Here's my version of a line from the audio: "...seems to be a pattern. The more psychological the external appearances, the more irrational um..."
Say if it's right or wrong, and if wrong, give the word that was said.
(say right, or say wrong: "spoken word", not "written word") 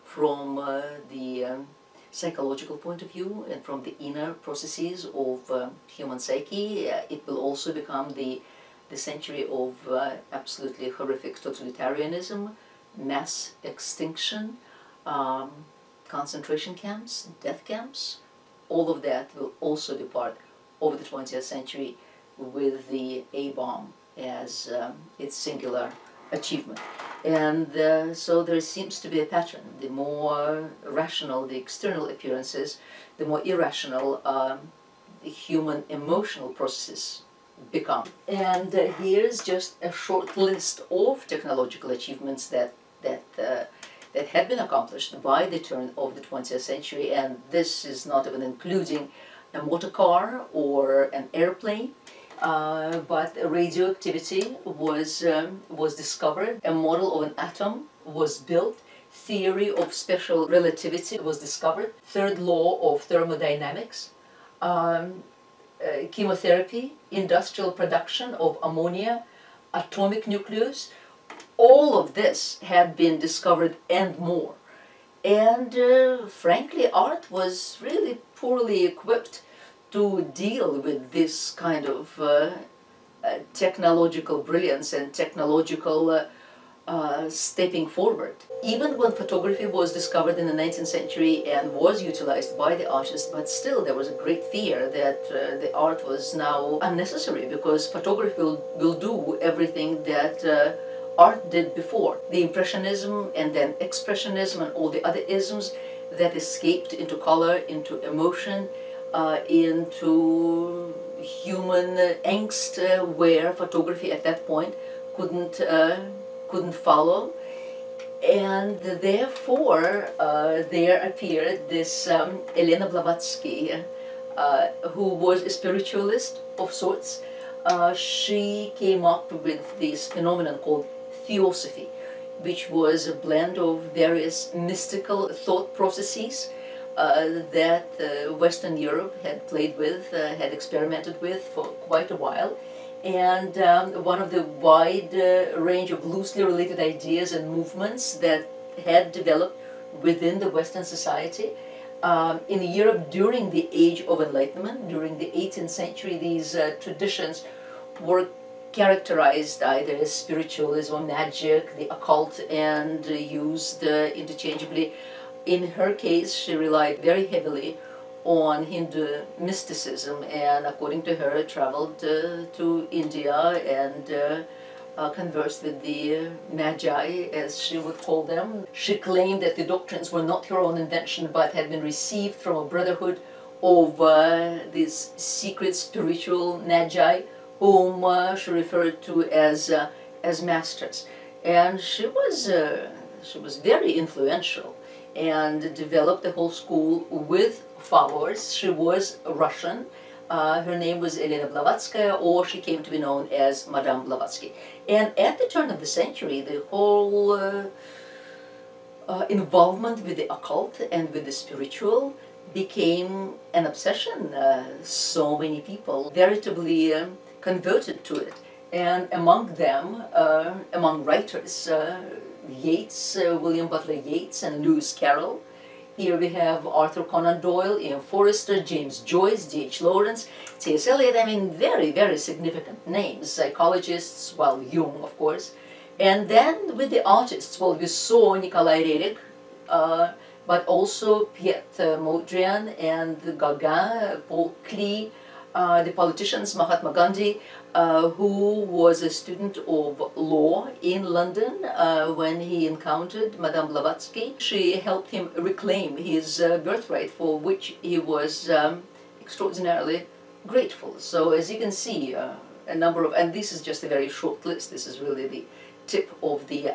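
wrong: "rational", not "psychological".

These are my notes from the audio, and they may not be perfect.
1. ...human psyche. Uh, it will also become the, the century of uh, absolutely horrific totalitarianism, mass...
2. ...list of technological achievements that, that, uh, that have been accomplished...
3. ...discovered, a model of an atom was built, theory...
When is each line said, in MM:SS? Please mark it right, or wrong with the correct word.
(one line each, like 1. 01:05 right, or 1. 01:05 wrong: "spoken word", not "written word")
1. 00:05 right
2. 00:40 right
3. 00:55 right.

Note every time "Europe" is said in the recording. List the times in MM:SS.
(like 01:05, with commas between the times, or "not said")
02:18, 02:32.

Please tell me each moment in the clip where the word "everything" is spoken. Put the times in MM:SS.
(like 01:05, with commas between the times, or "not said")
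01:39.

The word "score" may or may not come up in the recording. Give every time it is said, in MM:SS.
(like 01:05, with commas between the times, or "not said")
not said.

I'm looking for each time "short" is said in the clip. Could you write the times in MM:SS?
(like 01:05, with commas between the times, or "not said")
00:39, 04:24.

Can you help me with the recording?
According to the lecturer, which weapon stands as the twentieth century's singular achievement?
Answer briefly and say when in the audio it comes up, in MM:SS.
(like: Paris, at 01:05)
A-bomb, at 00:23.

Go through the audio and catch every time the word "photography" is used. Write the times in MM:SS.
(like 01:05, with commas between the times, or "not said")
01:29, 01:37, 01:53.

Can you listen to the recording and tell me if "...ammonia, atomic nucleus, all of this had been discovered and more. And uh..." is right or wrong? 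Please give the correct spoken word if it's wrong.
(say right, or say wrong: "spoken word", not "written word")
right.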